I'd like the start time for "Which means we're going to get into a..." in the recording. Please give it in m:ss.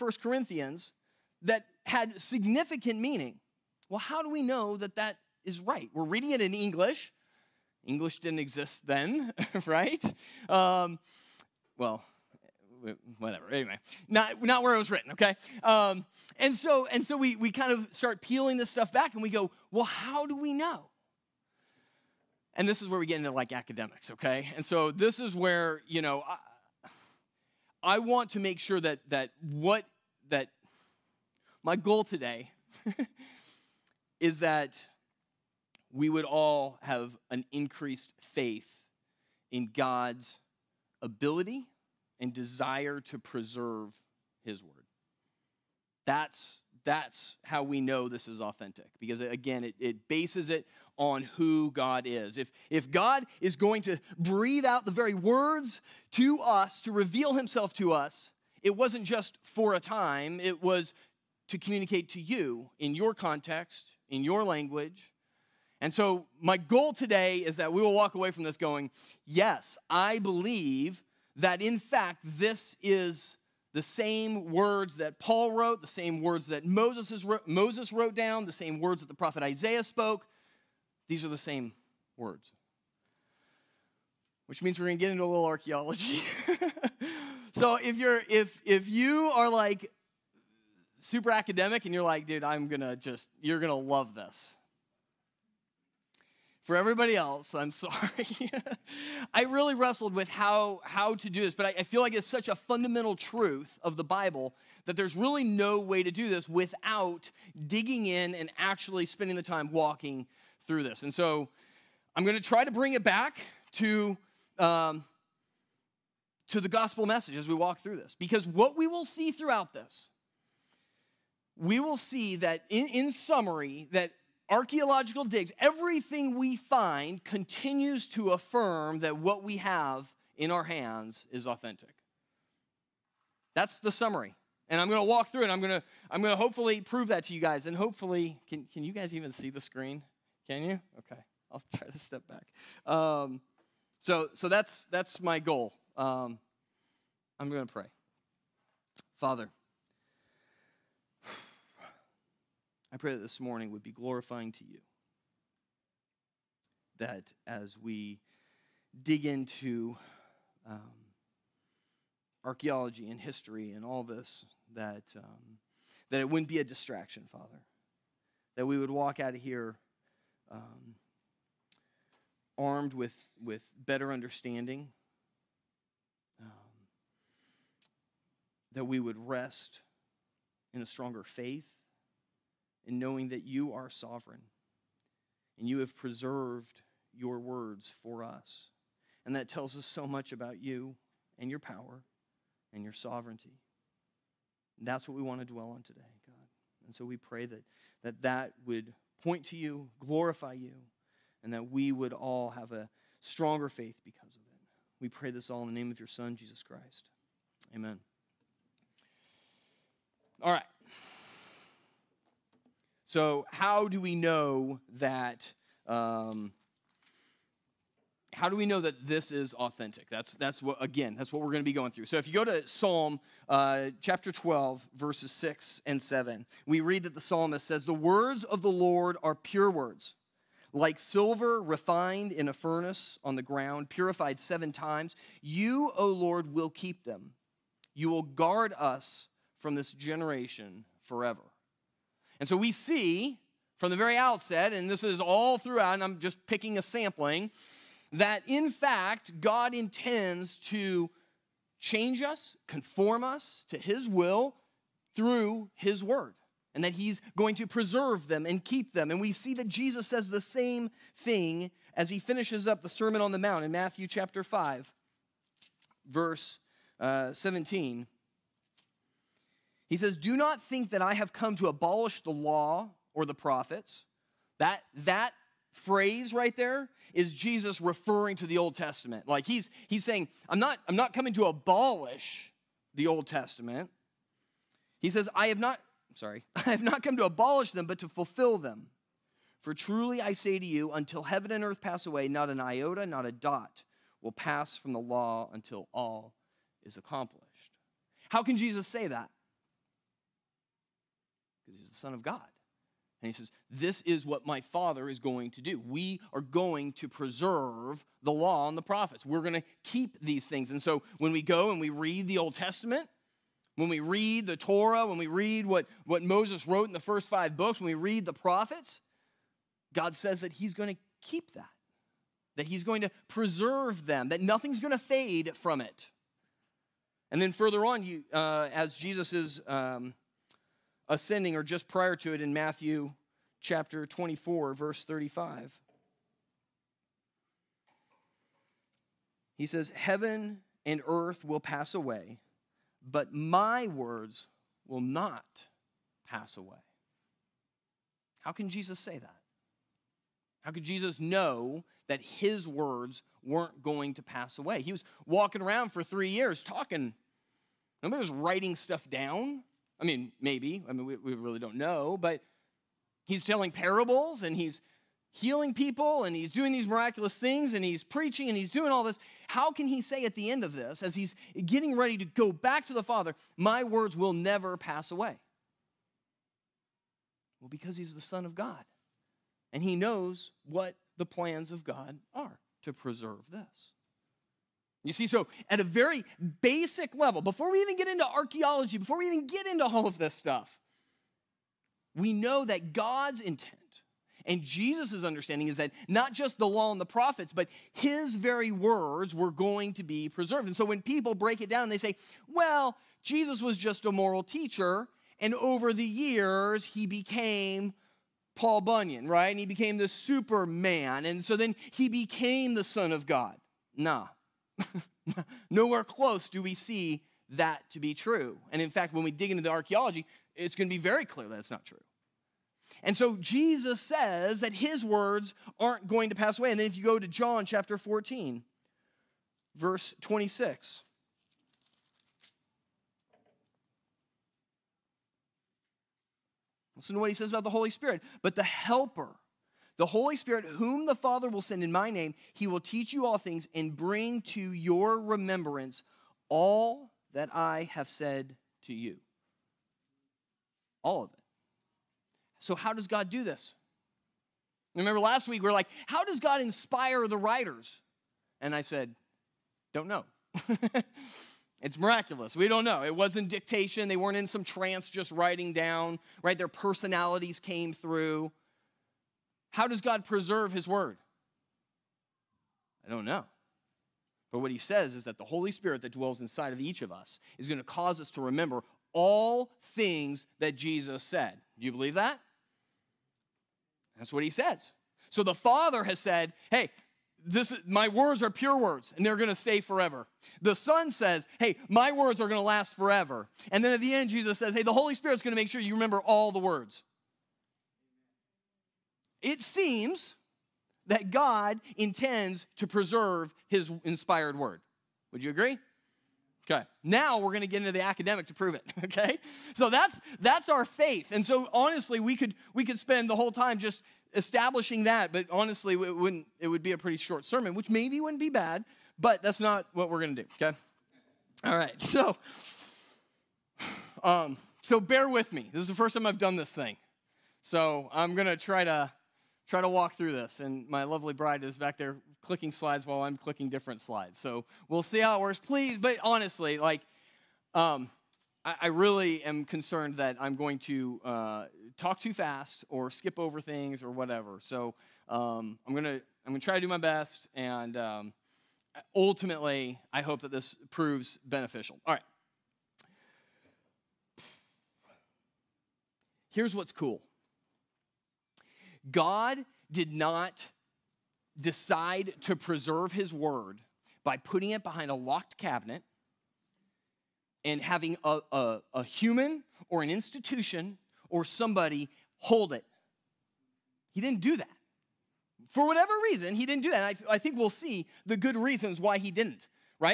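1:24.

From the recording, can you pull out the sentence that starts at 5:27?
And then further on, you, uh, as Jesus is.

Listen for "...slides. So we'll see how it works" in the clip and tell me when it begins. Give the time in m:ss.
8:54.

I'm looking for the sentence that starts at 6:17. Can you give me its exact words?
Well, because he's the Son of God and he knows what the plans of God are to preserve this.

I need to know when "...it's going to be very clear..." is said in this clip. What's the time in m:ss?
7:00.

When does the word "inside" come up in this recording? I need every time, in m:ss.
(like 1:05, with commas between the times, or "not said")
7:56.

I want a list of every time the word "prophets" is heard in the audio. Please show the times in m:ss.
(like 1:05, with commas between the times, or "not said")
1:19, 4:33, 5:08, 5:18, 6:37.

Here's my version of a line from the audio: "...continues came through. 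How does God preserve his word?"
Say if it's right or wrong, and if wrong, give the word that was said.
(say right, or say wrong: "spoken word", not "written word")
wrong: "personalities", not "continues".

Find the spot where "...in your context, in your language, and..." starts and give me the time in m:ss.
1:02.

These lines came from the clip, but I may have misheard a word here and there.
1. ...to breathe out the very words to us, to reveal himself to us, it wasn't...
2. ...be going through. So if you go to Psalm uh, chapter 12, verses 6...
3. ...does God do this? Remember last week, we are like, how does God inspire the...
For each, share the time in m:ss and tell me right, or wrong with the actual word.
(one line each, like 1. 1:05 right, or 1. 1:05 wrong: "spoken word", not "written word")
1. 0:53 right
2. 3:41 right
3. 7:32 right.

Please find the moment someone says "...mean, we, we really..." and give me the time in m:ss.
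6:00.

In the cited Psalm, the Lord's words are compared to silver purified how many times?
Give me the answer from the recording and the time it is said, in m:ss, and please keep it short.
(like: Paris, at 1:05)
7, at 3:54.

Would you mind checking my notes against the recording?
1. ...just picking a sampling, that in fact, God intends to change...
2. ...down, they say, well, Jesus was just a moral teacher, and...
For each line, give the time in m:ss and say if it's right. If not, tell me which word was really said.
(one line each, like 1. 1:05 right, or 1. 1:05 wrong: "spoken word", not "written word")
1. 4:06 right
2. 6:41 right.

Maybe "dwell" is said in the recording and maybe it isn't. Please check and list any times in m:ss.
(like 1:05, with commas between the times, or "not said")
3:15, 7:56.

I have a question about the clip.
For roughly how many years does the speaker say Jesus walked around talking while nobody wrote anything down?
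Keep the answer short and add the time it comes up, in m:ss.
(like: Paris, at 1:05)
3, at 5:56.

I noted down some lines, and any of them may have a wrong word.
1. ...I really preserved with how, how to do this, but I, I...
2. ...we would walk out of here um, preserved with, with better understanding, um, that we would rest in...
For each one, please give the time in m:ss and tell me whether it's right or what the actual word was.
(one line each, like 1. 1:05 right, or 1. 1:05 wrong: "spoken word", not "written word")
1. 1:39 wrong: "wrestled", not "preserved"
2. 2:48 wrong: "armed", not "preserved".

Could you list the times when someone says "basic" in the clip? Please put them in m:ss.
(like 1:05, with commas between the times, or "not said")
6:26.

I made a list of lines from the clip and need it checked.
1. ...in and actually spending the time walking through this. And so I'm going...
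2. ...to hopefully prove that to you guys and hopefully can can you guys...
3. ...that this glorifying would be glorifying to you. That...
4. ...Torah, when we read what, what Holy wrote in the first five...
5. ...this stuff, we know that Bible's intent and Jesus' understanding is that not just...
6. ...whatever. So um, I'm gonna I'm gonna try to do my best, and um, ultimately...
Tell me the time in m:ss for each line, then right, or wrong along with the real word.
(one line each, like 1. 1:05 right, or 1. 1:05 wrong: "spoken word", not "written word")
1. 1:48 right
2. 2:16 right
3. 2:33 wrong: "morning", not "glorifying"
4. 5:14 wrong: "Moses", not "Holy"
5. 6:30 wrong: "God", not "Bible"
6. 9:04 right.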